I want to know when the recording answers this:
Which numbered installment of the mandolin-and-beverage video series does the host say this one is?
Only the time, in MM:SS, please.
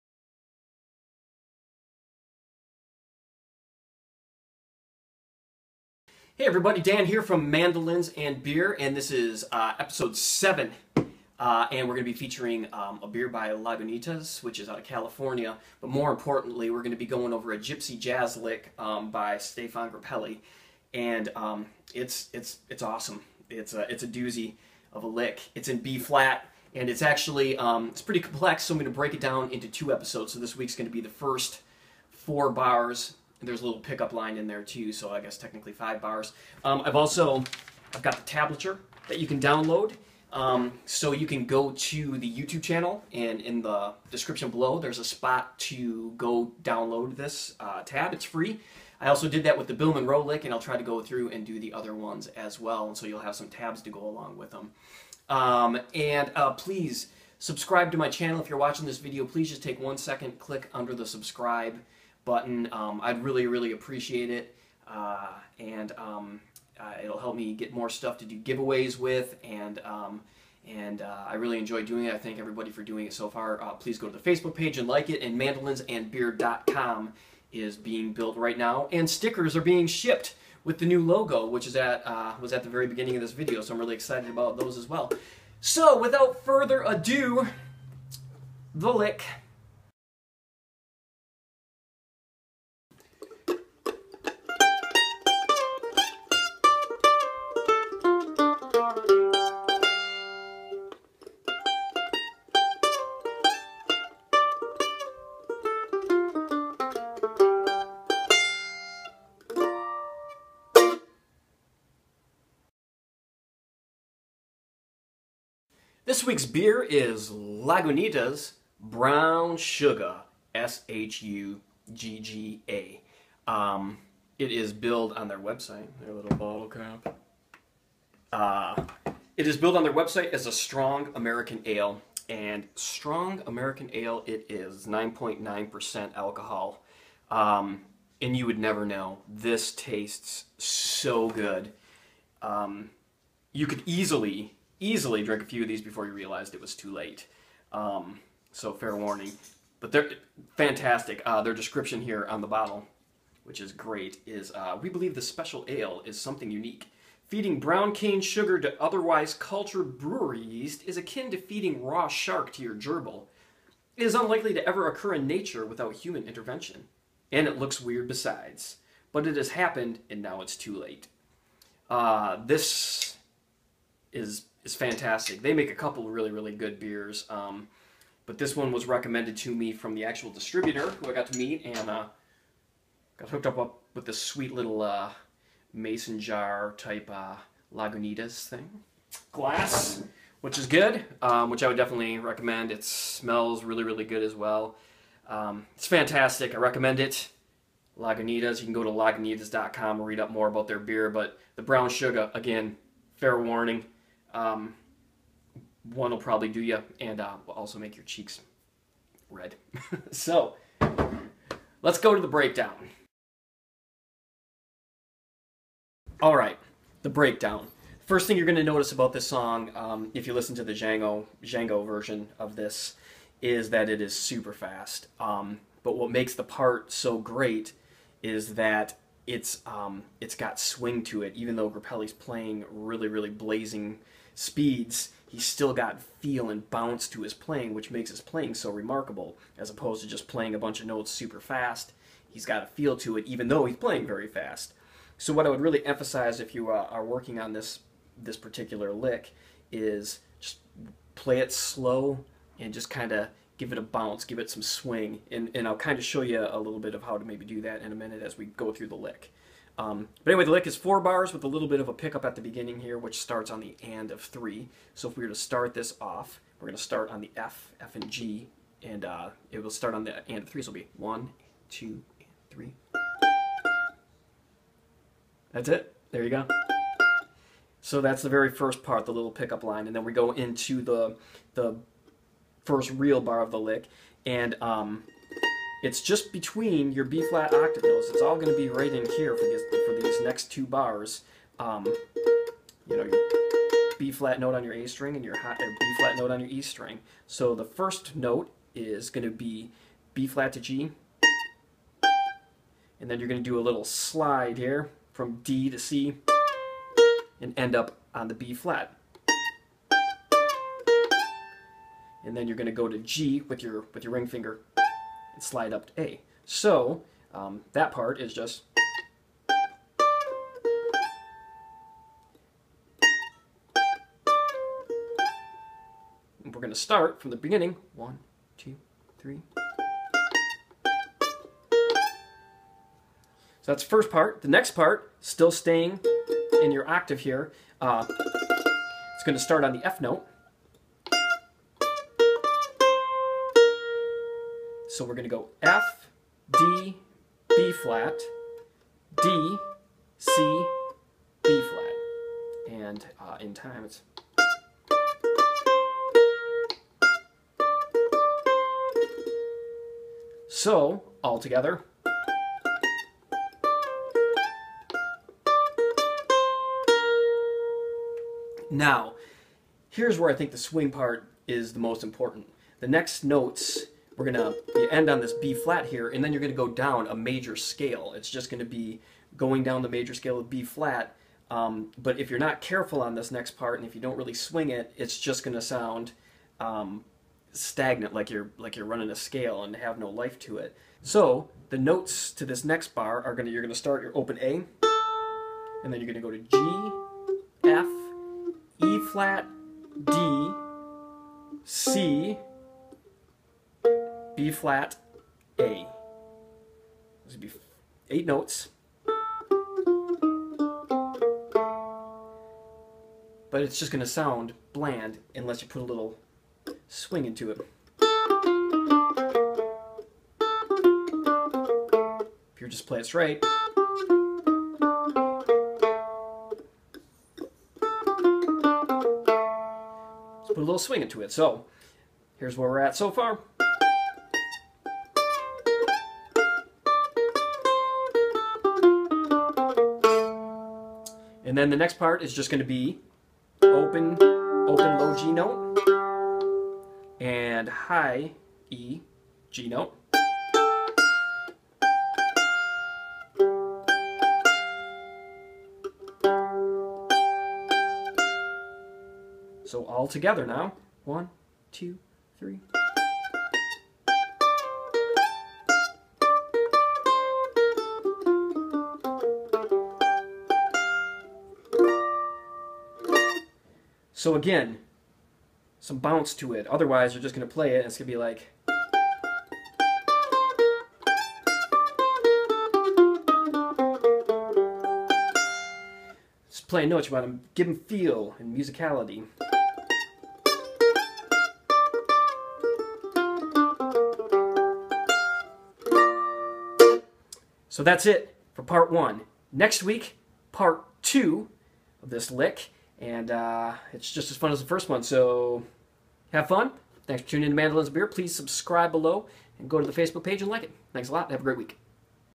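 00:09.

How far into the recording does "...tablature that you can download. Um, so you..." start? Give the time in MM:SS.
00:38.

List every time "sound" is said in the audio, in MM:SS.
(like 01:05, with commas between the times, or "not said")
06:25, 06:54.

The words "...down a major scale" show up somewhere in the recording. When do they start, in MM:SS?
06:16.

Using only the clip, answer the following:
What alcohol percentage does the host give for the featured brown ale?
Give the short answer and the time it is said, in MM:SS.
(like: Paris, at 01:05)
9.9%, at 02:14.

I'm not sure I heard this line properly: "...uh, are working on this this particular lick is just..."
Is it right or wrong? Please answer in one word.
right.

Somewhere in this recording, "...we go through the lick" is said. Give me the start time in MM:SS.
04:18.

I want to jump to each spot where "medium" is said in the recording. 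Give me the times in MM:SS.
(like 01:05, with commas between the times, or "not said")
not said.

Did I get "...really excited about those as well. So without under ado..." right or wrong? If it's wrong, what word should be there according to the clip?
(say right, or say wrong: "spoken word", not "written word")
wrong: "further", not "under".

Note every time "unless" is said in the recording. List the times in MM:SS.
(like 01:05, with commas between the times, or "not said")
06:55.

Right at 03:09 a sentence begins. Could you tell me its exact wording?
Glass, which is good, um, which I would definitely recommend.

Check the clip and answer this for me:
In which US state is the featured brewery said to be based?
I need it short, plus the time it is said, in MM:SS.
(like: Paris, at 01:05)
California, at 00:14.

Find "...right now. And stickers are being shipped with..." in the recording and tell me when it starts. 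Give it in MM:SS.
01:18.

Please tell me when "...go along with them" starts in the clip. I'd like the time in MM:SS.
00:53.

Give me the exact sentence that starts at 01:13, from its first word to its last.
Uh, please go to the Facebook page and like it.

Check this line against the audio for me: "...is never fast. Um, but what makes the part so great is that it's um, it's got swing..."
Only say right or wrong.
wrong.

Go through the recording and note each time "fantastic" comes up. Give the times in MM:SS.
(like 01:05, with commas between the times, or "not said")
02:30, 02:54, 03:15.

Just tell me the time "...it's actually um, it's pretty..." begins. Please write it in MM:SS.
00:26.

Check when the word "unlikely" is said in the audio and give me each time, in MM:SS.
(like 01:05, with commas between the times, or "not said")
02:44.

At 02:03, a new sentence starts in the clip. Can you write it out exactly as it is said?
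Um, it is billed on their website, their little bottle cap.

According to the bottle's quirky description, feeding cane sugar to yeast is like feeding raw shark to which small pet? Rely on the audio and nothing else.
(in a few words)
gerbil.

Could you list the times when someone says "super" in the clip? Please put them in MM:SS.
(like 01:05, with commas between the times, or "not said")
03:44, 04:01.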